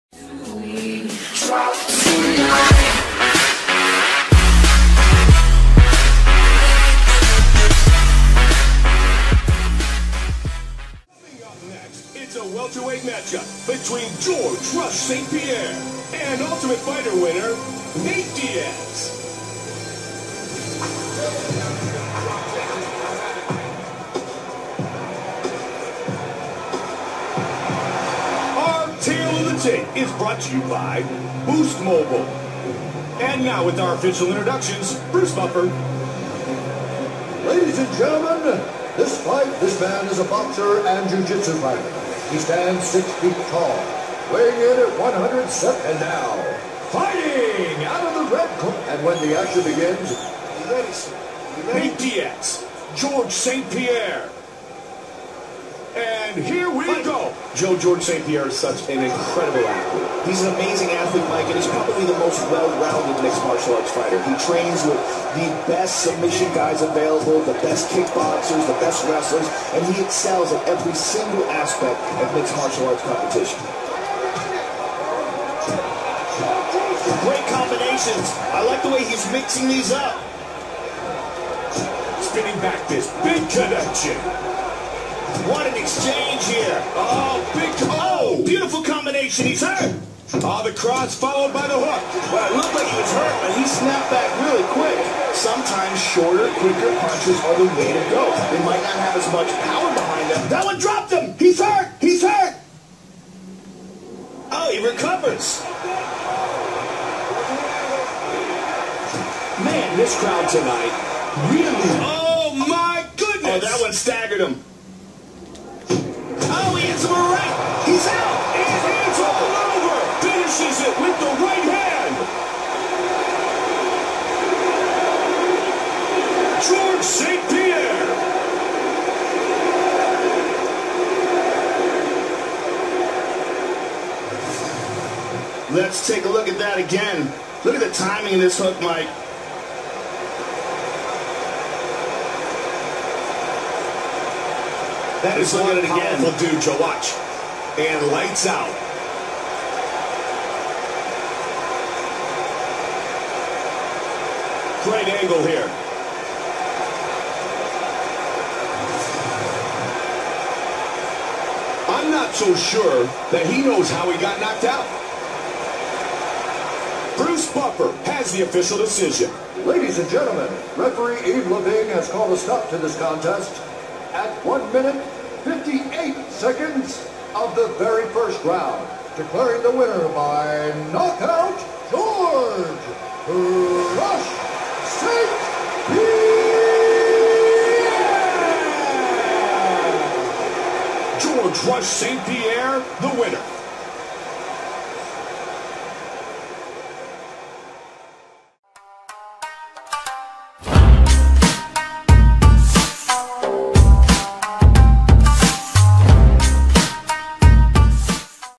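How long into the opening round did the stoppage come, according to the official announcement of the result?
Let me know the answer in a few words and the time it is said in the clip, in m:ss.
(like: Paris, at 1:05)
1 minute 58 seconds, at 2:54.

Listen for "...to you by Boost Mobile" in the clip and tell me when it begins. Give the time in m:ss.
0:30.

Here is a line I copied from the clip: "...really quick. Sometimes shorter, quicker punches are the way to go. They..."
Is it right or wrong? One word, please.
right.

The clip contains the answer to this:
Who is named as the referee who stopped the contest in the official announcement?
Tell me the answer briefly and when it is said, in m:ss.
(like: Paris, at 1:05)
Yves Lavigne, at 2:51.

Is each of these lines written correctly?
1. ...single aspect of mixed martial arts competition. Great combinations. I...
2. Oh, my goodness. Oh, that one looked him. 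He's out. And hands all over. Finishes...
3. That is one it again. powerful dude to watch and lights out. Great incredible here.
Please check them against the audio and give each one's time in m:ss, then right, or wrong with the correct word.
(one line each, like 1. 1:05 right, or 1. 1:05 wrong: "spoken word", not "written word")
1. 1:10 right
2. 1:52 wrong: "staggered", not "looked"
3. 2:25 wrong: "angle", not "incredible".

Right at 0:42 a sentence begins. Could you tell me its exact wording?
He stands six feet tall, weighing in at 107 and now, fighting out of the red corner.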